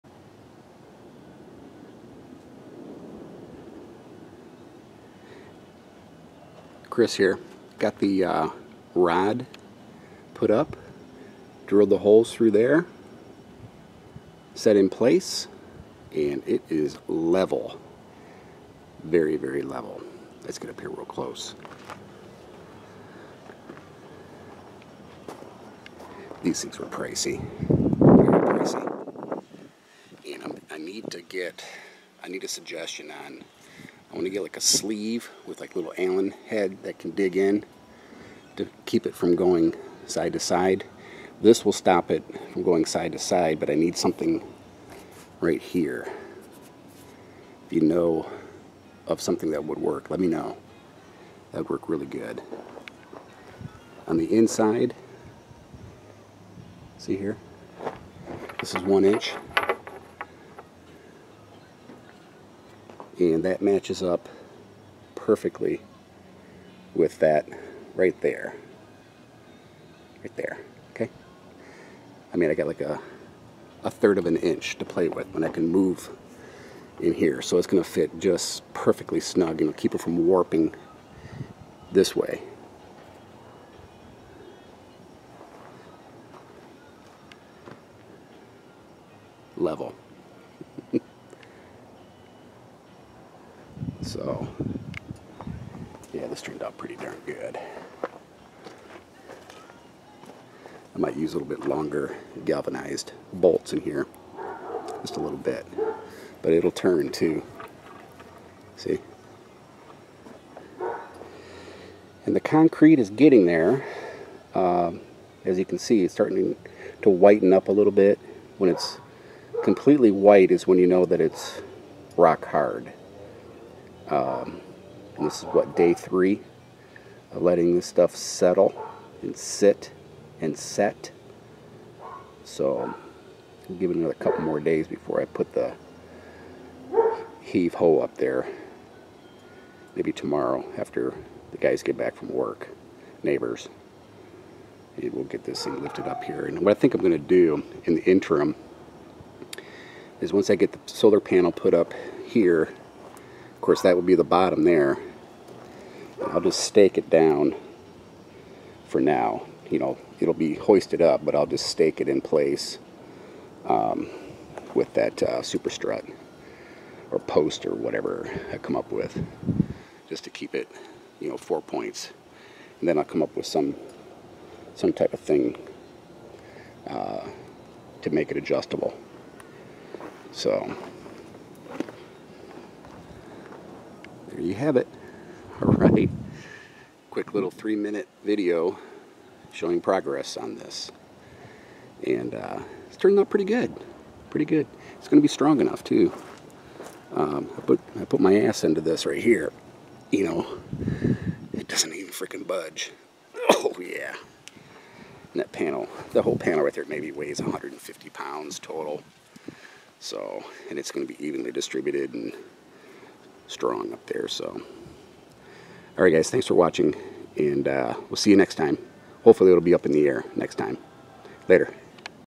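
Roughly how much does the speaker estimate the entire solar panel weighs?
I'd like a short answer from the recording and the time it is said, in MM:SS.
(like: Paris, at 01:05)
150 pounds, at 03:27.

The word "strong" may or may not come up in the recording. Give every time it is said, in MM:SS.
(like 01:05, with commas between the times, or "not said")
03:15, 03:33.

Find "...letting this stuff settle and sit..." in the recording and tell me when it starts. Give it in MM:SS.
02:07.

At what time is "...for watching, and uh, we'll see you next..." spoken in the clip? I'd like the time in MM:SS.
03:36.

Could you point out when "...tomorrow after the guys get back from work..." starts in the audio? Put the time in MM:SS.
02:20.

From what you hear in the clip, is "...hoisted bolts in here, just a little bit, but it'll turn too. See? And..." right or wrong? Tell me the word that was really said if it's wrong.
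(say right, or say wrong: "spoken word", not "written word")
wrong: "galvanized", not "hoisted".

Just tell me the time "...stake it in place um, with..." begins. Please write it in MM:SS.
02:41.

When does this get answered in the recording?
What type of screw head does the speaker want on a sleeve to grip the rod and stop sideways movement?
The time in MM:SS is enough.
00:35.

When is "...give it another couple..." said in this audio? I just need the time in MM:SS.
02:13.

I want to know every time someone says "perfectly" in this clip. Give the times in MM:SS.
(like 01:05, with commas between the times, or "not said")
01:05, 01:18.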